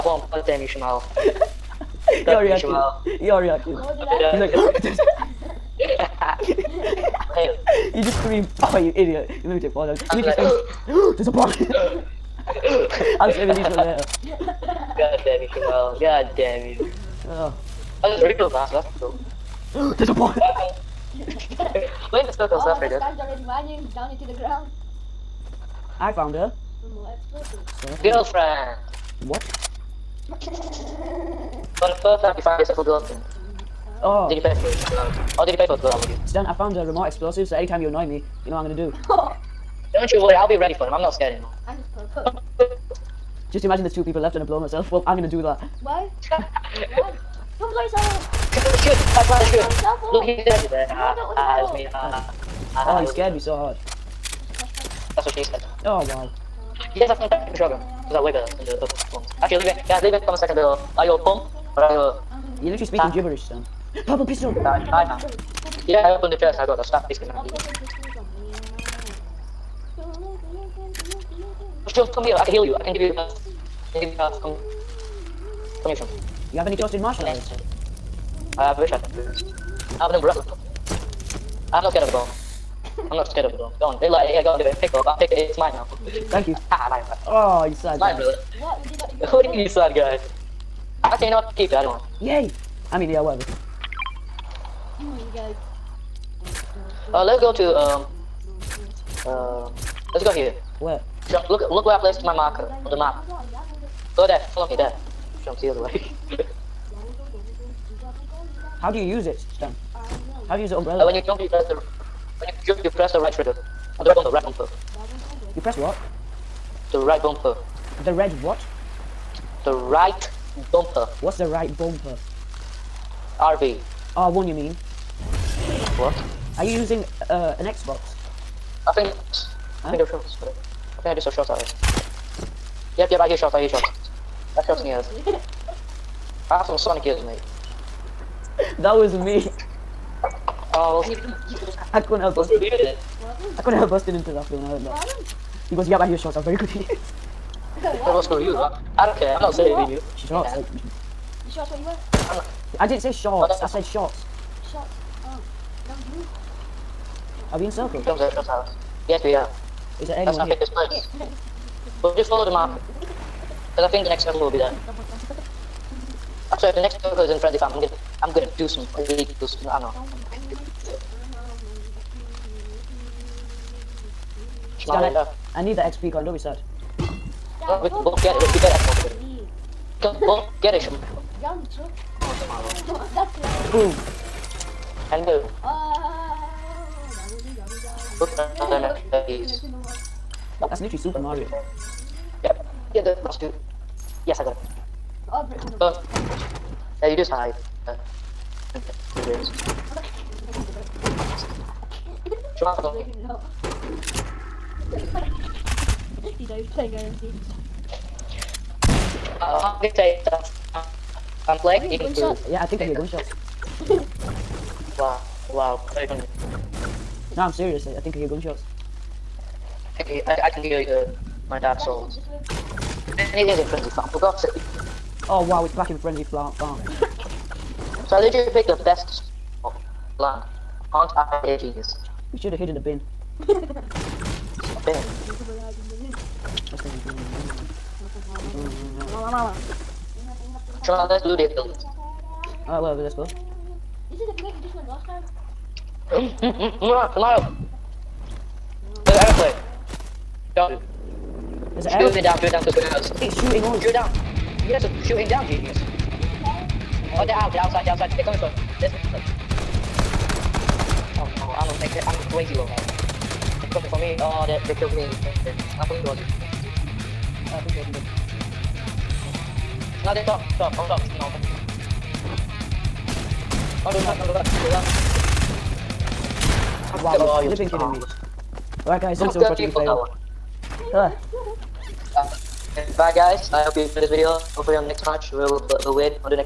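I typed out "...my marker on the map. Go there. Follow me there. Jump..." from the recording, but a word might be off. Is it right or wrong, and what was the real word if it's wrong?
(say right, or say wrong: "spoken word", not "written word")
right.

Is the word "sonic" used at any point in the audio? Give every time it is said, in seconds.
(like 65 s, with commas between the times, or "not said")
136 s.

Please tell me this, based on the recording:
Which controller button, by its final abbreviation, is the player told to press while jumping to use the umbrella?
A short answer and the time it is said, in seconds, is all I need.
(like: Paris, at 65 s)
RB, at 123 s.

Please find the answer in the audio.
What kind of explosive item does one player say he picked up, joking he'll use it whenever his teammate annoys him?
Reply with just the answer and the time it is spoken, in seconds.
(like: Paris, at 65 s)
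Remote explosive, at 36 s.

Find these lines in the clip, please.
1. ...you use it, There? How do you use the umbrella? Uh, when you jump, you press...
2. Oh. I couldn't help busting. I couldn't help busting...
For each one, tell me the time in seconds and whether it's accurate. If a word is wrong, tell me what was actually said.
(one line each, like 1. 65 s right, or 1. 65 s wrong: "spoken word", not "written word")
1. 108 s wrong: "Stan", not "There"
2. 140 s right.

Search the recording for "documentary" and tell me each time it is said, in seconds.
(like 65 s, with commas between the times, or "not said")
not said.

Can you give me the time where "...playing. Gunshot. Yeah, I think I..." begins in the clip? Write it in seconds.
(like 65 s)
211 s.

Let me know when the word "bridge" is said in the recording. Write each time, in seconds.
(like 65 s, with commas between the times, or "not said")
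not said.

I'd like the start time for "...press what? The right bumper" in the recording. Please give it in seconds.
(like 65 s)
115 s.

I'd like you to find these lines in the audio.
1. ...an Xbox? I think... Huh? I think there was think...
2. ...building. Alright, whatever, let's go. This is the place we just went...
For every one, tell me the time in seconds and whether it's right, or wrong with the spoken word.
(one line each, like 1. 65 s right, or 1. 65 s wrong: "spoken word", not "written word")
1. 127 s right
2. 241 s right.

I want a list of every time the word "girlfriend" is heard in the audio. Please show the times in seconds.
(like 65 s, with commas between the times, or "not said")
28 s, 32 s.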